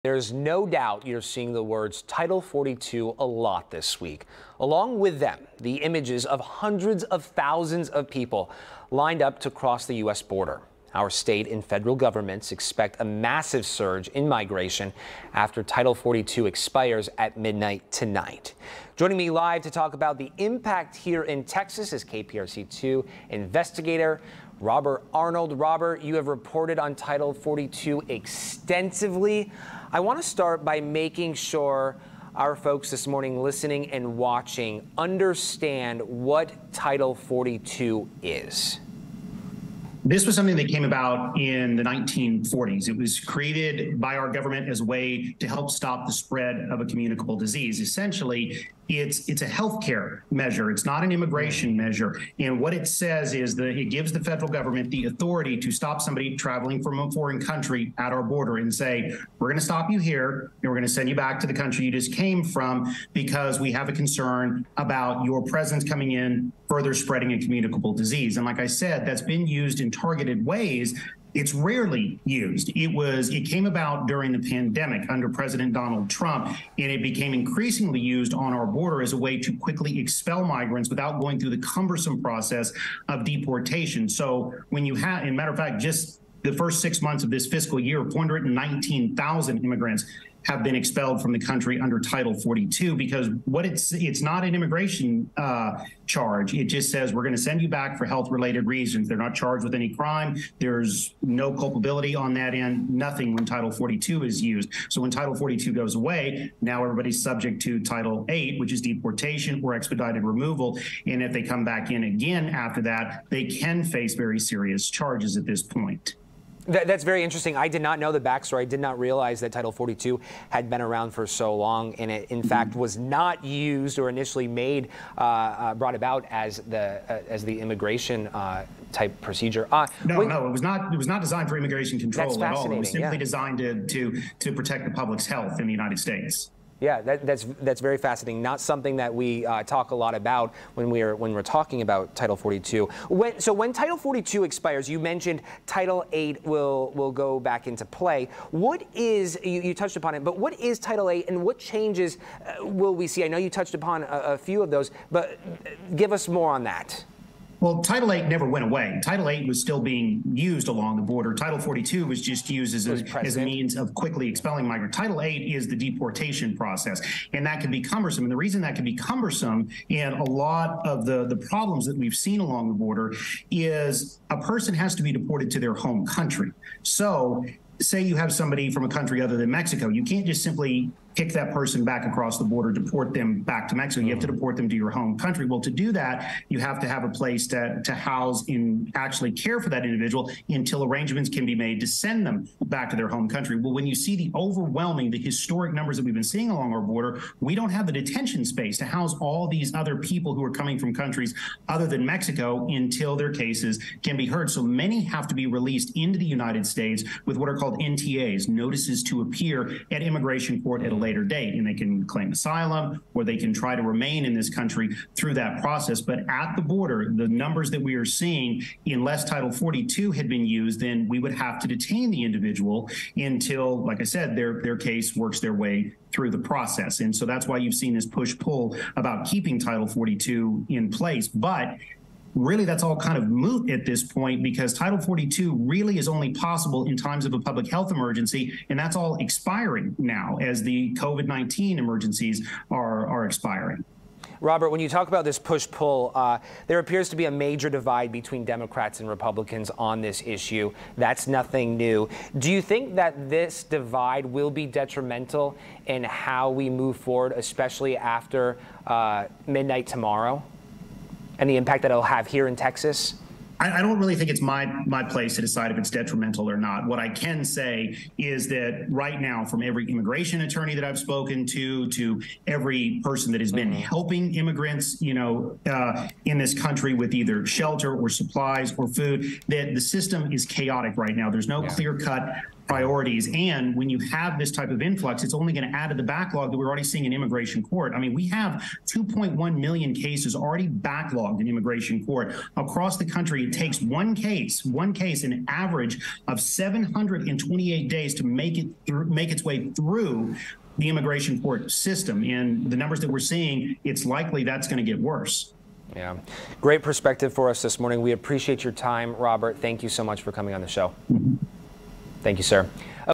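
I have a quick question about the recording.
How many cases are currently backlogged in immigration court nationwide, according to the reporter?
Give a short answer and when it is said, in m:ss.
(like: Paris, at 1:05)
2.1 million, at 4:48.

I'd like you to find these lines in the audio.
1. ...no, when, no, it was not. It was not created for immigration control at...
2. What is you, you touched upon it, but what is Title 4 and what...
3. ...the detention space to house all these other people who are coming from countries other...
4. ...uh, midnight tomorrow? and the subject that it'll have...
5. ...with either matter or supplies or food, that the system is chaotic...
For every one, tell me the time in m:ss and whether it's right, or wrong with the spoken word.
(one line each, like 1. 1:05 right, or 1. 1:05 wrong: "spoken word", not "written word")
1. 2:10 wrong: "designed", not "created"
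2. 2:28 wrong: "8", not "4"
3. 3:17 right
4. 4:18 wrong: "impact", not "subject"
5. 4:36 wrong: "shelter", not "matter".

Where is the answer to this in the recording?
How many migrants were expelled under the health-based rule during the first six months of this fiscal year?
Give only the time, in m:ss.
1:28.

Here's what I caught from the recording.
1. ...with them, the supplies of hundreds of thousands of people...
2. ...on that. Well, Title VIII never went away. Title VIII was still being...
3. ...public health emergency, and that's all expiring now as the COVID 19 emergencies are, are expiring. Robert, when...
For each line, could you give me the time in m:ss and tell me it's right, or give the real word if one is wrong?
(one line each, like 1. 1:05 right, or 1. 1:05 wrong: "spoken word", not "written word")
1. 0:04 wrong: "images", not "supplies"
2. 2:36 right
3. 3:57 right.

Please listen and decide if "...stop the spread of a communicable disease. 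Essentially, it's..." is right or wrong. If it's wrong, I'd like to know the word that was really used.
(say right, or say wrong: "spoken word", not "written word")
right.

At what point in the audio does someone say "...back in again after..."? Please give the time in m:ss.
1:51.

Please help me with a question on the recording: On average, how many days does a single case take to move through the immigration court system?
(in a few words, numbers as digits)
728.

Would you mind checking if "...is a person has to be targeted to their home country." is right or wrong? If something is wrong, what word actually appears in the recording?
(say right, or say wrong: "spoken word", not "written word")
wrong: "deported", not "targeted".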